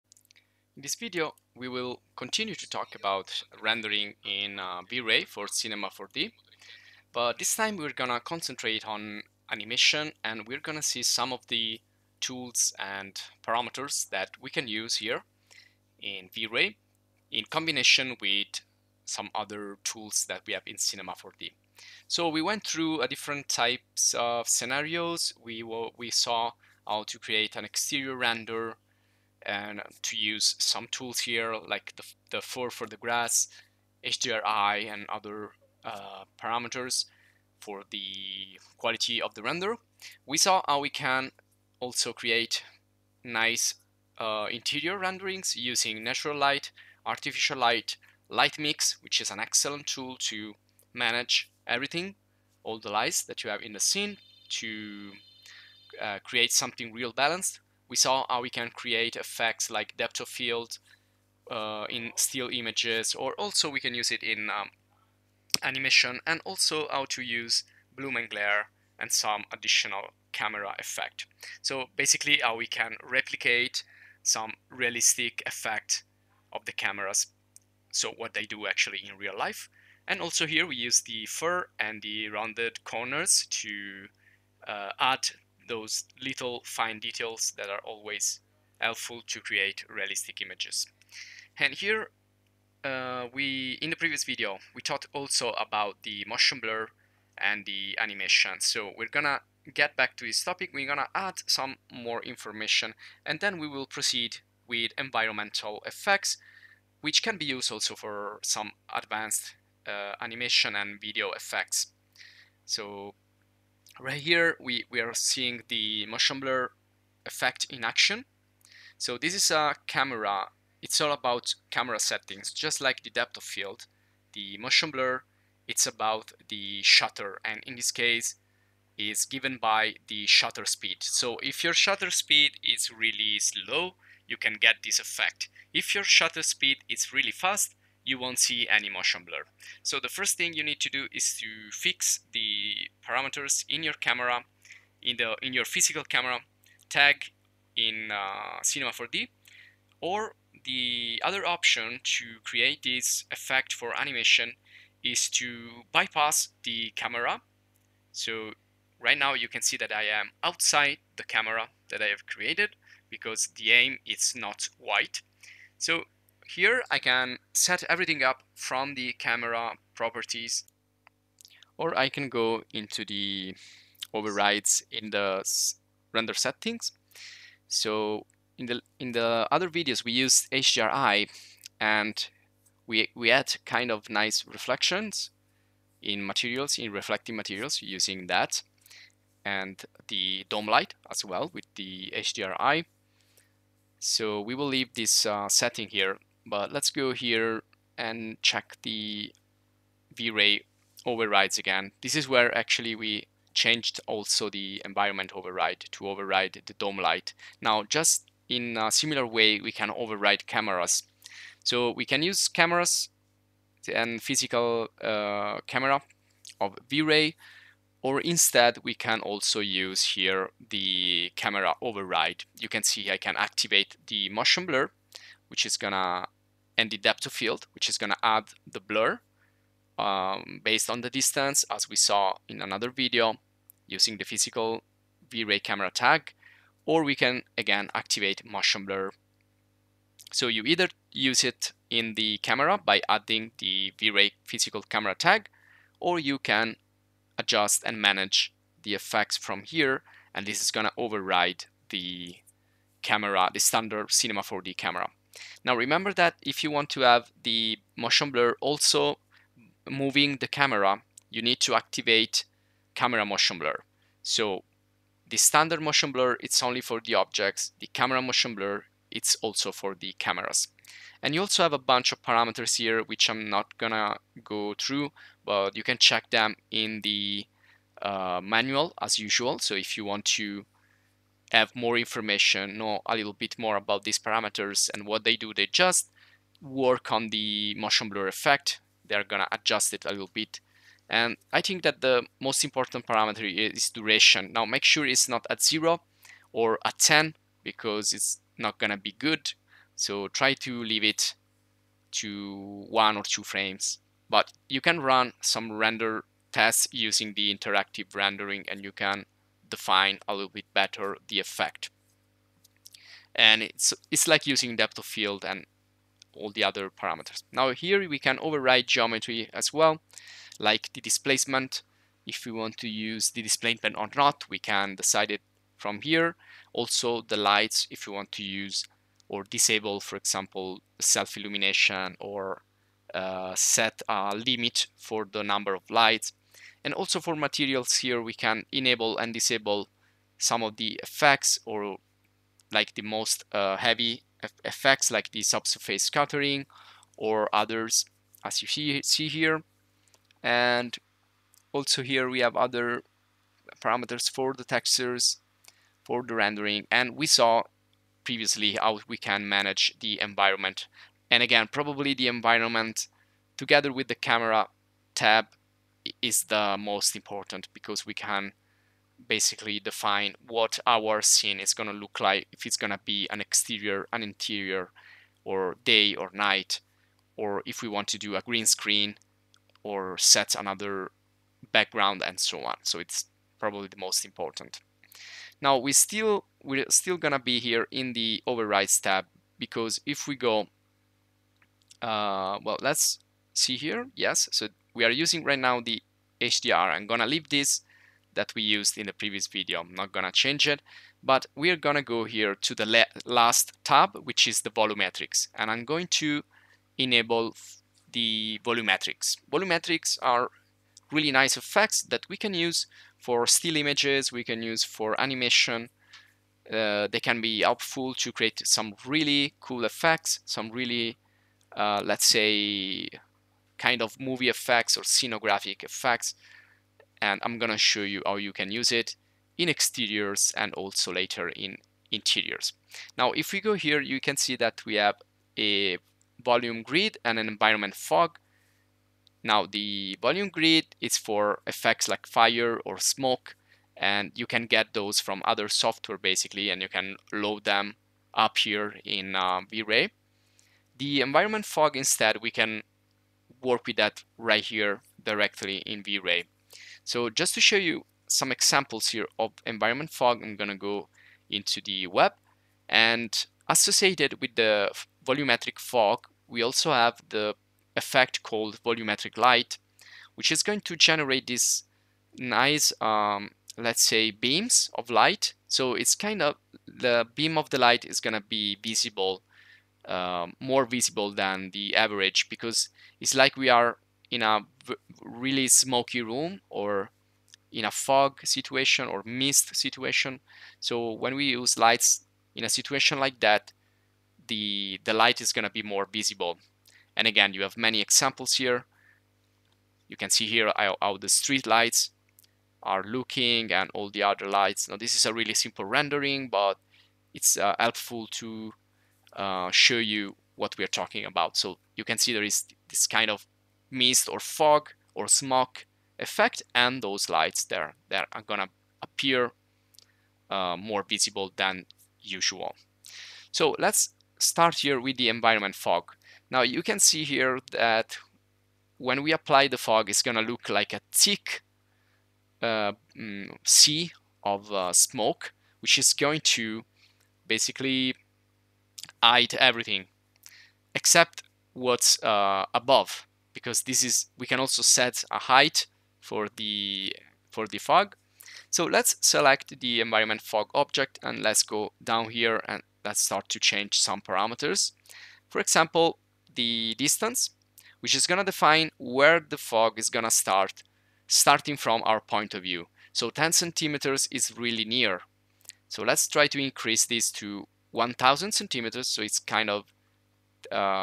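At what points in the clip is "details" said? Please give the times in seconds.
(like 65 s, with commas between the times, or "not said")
86 s.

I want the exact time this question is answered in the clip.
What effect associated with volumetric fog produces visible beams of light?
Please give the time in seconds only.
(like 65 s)
468 s.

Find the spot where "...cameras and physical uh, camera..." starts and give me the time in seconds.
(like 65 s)
212 s.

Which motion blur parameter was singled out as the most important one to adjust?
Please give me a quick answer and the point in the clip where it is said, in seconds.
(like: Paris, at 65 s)
Duration, at 293 s.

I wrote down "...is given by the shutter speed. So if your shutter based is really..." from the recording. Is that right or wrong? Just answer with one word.
wrong.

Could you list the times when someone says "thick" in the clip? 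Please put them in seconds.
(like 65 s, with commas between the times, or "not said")
531 s.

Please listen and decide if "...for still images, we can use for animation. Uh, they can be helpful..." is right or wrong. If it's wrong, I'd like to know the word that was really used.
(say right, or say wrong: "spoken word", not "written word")
right.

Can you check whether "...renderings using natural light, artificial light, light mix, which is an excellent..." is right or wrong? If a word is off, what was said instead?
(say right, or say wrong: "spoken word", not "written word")
right.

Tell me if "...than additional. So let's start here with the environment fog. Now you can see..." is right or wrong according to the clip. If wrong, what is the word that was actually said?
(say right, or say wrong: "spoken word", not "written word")
wrong: "usual", not "additional".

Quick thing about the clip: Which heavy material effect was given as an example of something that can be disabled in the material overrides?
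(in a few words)
Subsurface scattering.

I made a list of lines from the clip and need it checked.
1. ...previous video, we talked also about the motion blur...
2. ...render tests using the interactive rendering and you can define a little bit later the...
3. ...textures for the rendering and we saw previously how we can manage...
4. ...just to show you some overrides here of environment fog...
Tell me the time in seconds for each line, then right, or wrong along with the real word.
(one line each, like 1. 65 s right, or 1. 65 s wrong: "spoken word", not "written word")
1. 93 s right
2. 305 s wrong: "better", not "later"
3. 354 s right
4. 457 s wrong: "examples", not "overrides".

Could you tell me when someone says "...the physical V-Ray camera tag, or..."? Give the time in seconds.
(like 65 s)
234 s.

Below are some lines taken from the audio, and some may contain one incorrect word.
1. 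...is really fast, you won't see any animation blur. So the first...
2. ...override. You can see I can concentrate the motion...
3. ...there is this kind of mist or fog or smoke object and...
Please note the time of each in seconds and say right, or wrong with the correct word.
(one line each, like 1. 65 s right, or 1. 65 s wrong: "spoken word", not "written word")
1. 136 s wrong: "motion", not "animation"
2. 221 s wrong: "activate", not "concentrate"
3. 512 s wrong: "effect", not "object".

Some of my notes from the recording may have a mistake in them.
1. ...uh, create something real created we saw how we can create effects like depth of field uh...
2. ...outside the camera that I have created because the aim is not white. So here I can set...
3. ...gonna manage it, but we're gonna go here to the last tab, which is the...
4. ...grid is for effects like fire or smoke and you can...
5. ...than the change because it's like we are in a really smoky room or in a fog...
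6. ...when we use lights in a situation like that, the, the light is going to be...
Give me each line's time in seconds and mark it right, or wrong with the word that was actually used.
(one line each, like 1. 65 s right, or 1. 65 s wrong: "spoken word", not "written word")
1. 55 s wrong: "balanced", not "created"
2. 160 s right
3. 400 s wrong: "change", not "manage"
4. 440 s right
5. 481 s wrong: "average", not "change"
6. 491 s right.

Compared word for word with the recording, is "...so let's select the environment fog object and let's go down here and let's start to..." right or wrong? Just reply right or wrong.
right.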